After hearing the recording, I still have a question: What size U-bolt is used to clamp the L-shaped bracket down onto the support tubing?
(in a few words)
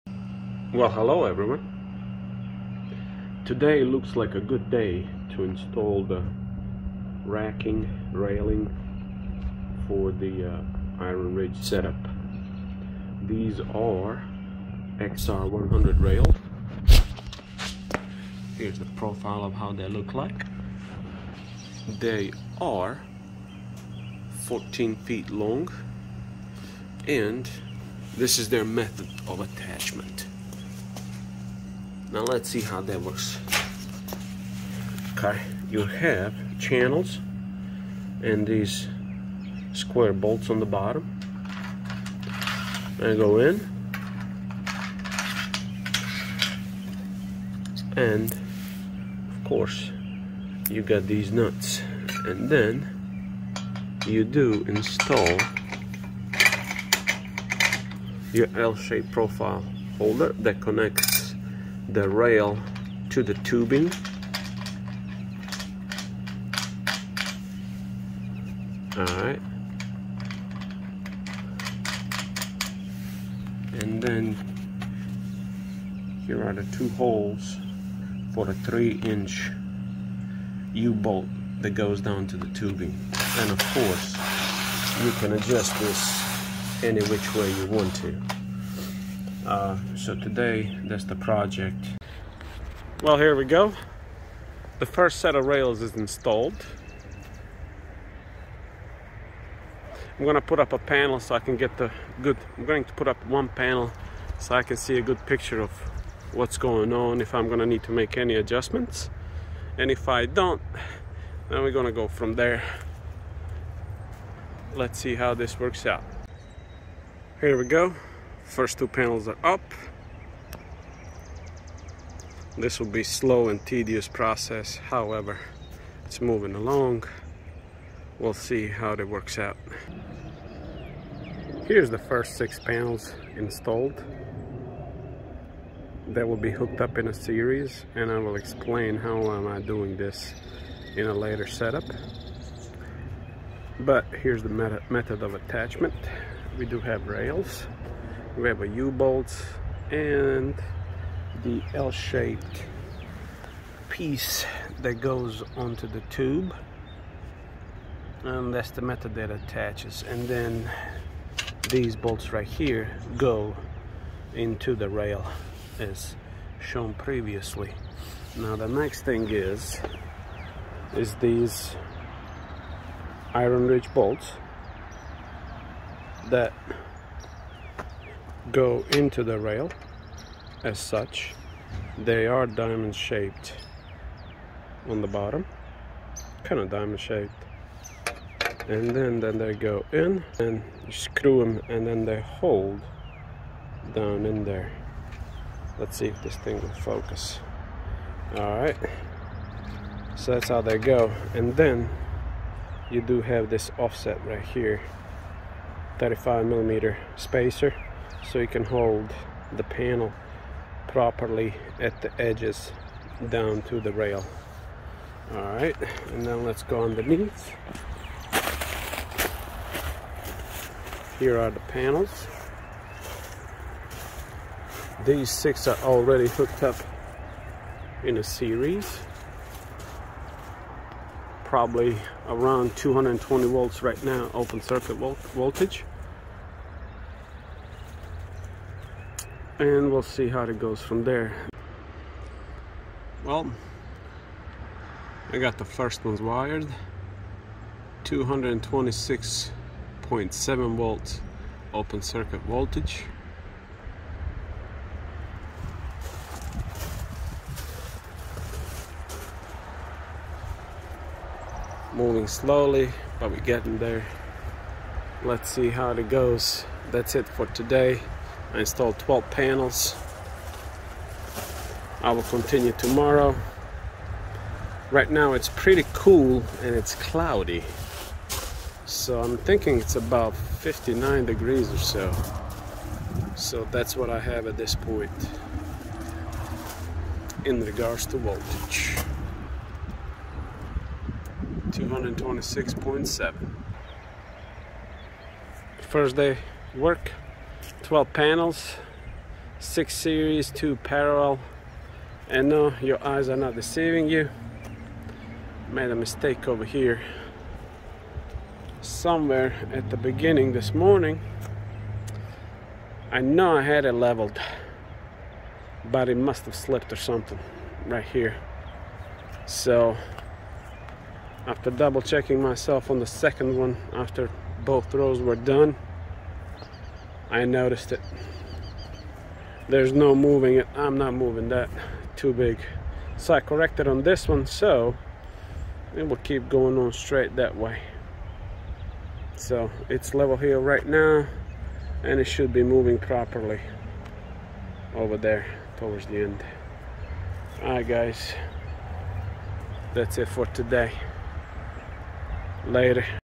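3 inch.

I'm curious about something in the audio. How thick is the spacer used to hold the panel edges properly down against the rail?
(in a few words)
35 millimeter.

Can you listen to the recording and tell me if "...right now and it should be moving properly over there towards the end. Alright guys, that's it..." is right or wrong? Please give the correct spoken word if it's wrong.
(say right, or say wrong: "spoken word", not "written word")
right.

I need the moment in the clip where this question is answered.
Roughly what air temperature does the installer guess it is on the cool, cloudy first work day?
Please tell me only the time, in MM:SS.
04:40.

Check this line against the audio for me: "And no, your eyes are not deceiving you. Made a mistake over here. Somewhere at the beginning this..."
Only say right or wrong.
right.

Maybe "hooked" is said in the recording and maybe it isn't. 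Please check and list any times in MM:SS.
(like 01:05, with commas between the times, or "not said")
02:16, 03:46.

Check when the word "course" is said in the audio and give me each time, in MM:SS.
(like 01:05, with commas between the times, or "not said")
00:49, 01:23.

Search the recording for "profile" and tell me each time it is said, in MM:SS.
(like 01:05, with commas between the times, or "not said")
00:18, 00:59.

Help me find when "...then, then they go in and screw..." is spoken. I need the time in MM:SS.
03:08.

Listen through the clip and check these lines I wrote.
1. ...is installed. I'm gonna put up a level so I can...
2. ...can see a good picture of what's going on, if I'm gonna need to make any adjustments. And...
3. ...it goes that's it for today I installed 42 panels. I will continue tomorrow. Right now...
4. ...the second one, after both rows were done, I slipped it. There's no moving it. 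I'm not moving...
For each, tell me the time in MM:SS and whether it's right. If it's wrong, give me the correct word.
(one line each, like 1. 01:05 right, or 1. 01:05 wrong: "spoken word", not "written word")
1. 01:35 wrong: "panel", not "level"
2. 01:44 right
3. 04:25 wrong: "12", not "42"
4. 05:22 wrong: "noticed", not "slipped".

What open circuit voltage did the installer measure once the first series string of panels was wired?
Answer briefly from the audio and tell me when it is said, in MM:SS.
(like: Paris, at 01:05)
226.7 volts, at 04:08.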